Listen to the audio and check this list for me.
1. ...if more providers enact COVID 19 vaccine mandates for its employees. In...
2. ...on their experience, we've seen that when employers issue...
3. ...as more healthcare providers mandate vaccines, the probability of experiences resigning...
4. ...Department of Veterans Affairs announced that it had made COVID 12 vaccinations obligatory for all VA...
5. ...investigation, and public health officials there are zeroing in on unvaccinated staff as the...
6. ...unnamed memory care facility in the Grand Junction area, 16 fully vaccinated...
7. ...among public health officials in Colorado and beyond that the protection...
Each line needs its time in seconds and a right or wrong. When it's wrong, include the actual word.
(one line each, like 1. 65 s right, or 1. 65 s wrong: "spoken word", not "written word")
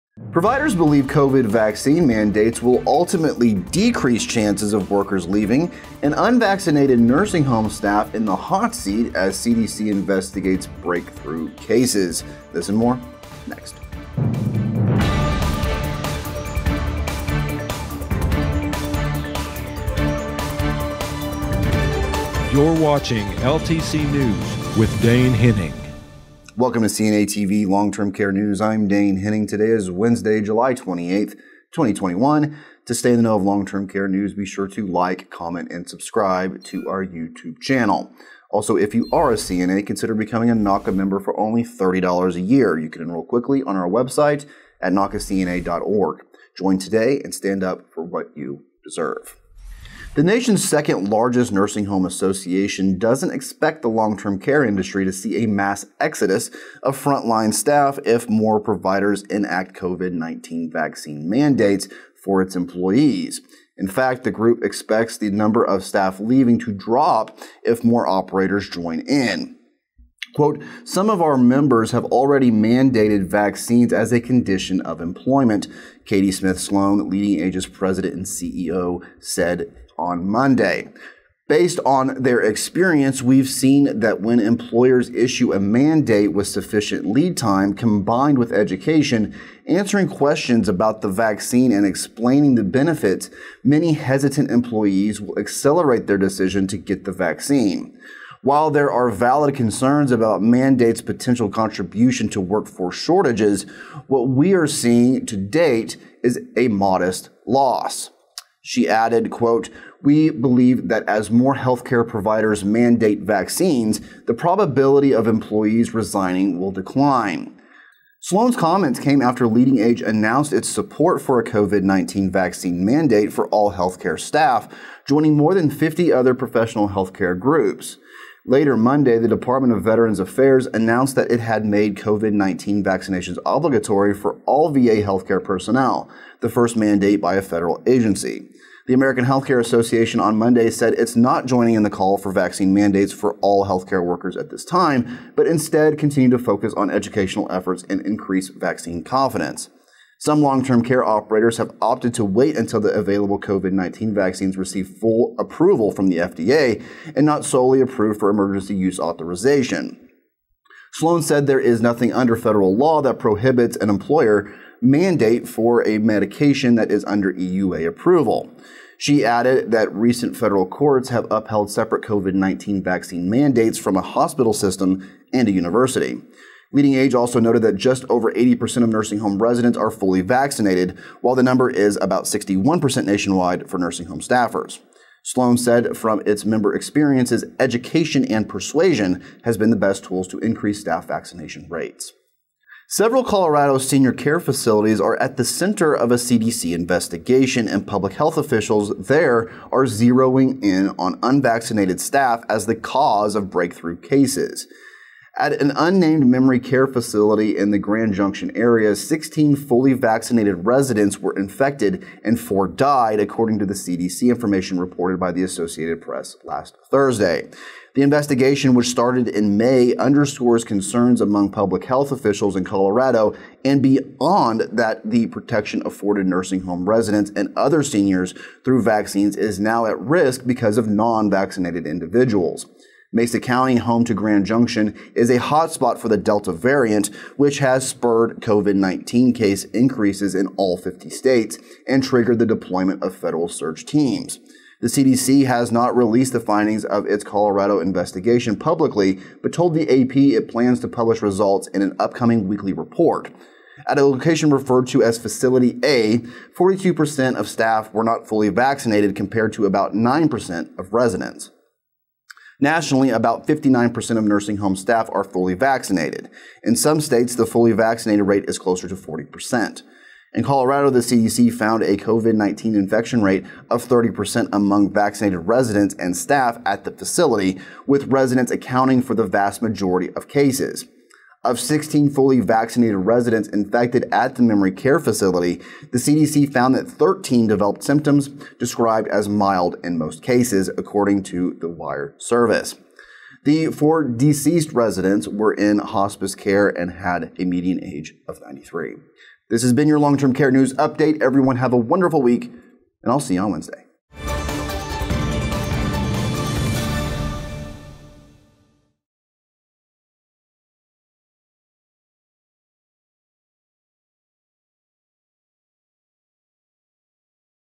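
1. 58 s right
2. 81 s right
3. 111 s wrong: "employees", not "experiences"
4. 129 s wrong: "19", not "12"
5. 196 s right
6. 205 s right
7. 221 s right.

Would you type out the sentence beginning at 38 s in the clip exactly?
Also, if you are a CNA, consider becoming a NAHCA member for only $30 a year.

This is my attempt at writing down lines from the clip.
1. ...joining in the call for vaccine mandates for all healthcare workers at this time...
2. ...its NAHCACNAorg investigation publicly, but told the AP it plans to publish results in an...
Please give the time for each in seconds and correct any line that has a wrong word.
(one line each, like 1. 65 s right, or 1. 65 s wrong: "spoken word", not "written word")
1. 141 s right
2. 247 s wrong: "Colorado", not "NAHCACNAorg".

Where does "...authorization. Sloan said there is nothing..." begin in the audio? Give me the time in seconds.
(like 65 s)
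158 s.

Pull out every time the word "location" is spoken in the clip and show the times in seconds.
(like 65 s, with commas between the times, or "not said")
254 s.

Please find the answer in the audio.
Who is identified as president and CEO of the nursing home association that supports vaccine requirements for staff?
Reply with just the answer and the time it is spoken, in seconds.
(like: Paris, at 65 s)
Katie Smith Sloan, at 76 s.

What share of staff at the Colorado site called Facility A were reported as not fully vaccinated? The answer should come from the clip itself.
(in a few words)
42%.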